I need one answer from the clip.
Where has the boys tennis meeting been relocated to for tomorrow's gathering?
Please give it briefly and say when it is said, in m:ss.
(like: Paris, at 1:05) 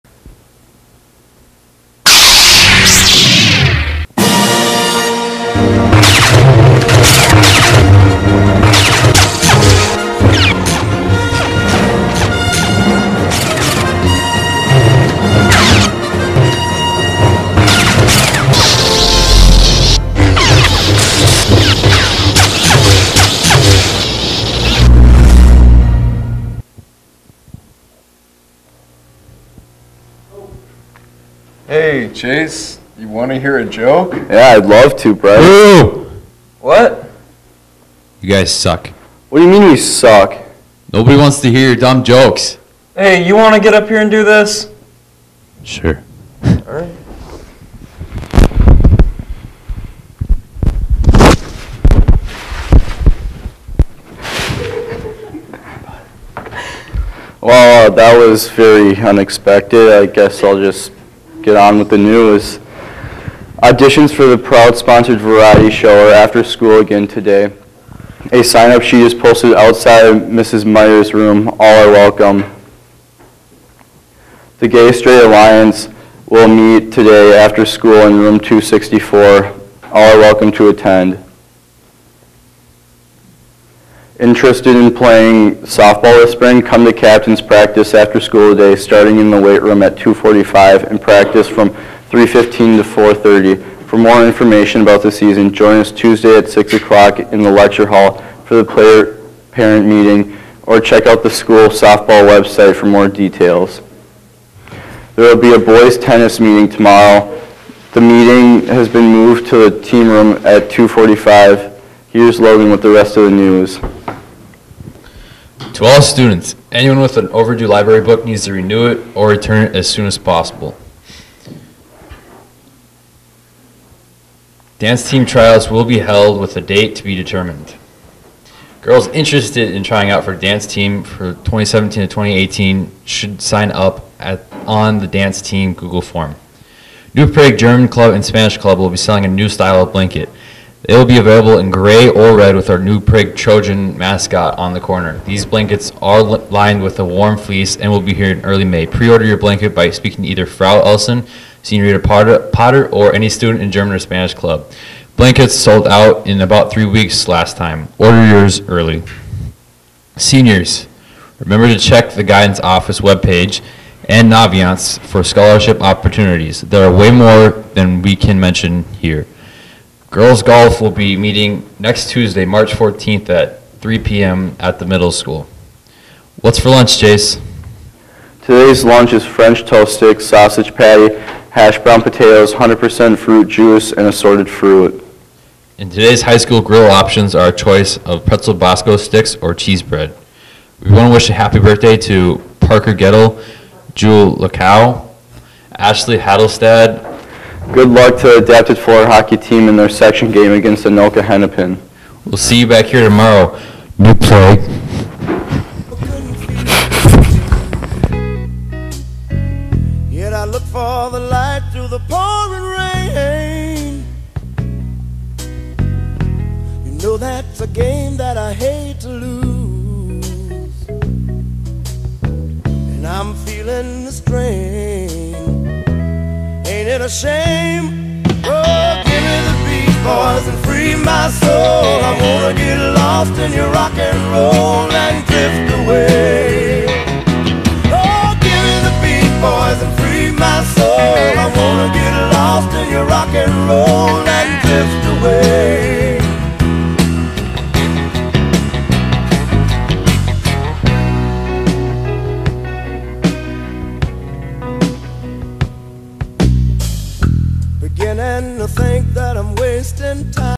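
the team room, at 1:49.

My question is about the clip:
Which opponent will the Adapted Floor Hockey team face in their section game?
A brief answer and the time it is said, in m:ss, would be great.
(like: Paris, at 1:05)
Anoka Hennepin, at 3:20.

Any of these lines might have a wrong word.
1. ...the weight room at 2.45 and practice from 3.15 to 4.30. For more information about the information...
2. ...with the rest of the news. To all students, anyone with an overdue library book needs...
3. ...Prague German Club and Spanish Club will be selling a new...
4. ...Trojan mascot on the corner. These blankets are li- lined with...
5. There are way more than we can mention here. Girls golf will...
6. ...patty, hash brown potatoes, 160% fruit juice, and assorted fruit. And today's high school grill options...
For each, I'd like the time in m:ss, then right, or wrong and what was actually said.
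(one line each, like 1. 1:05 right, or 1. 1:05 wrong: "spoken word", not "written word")
1. 1:29 wrong: "season", not "information"
2. 1:52 right
3. 2:17 right
4. 2:23 right
5. 2:46 right
6. 3:00 wrong: "100", not "160".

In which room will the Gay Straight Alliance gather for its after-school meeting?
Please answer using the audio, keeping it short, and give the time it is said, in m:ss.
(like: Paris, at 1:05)
264, at 1:18.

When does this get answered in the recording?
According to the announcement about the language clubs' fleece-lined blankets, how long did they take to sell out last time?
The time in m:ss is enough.
2:36.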